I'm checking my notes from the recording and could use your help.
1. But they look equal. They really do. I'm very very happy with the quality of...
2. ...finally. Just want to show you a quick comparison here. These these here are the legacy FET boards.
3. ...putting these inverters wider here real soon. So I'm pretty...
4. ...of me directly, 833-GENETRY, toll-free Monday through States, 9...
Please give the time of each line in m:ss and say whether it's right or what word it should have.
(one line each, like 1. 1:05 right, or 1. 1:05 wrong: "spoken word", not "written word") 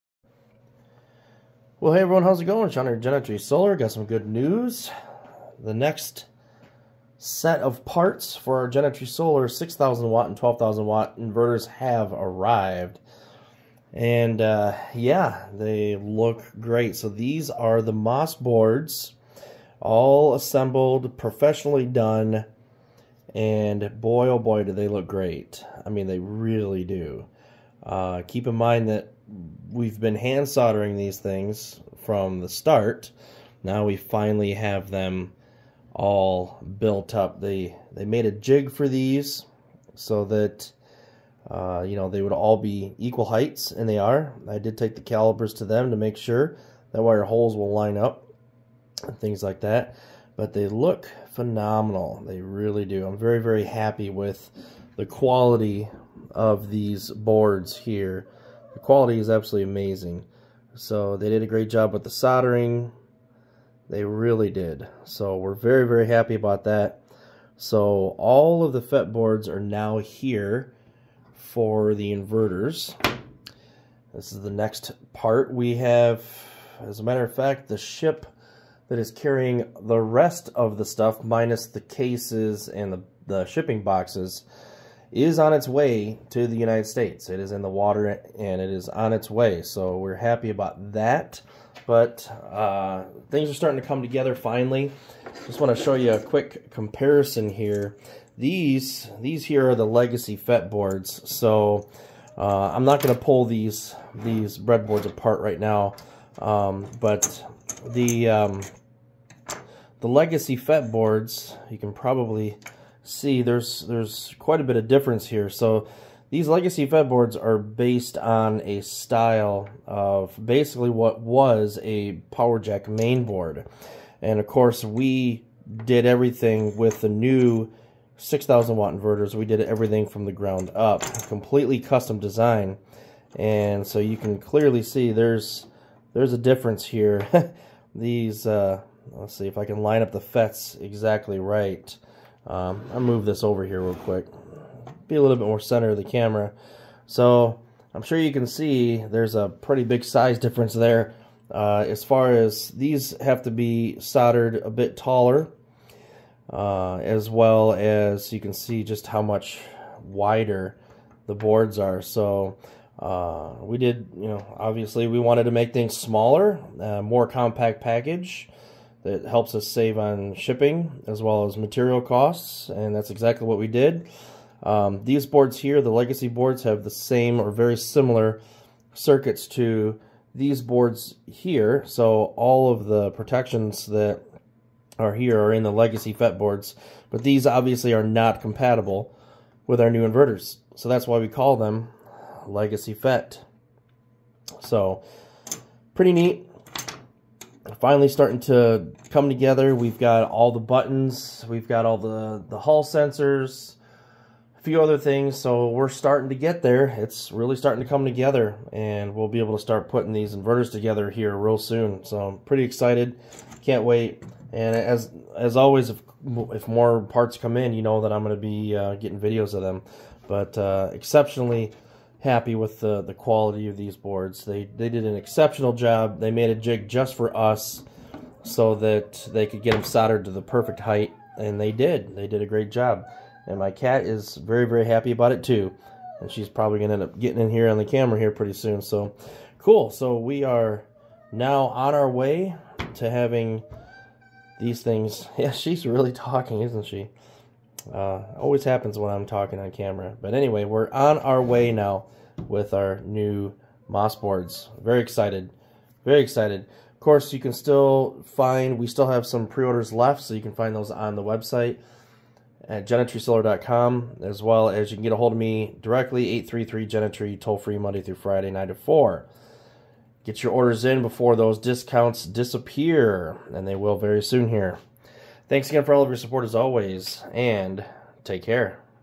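1. 0:50 wrong: "phenomenal", not "equal"
2. 1:34 right
3. 3:29 wrong: "together", not "wider"
4. 4:25 wrong: "Friday", not "States".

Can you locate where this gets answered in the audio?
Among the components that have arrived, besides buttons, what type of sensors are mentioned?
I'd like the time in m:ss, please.
3:22.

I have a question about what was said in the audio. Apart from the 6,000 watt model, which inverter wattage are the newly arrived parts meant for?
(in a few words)
12,000 watt.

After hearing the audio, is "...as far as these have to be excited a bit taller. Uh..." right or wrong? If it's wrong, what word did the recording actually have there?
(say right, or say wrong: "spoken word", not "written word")
wrong: "soldered", not "excited".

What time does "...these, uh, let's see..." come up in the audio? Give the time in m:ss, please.
2:17.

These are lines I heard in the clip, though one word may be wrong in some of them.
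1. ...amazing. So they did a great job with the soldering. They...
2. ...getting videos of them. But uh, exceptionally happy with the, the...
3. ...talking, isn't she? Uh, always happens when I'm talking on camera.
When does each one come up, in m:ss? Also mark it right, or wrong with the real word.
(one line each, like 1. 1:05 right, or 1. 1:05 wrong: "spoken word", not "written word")
1. 0:59 right
2. 3:38 right
3. 4:06 right.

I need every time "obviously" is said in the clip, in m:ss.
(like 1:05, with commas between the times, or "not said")
2:44, 3:07.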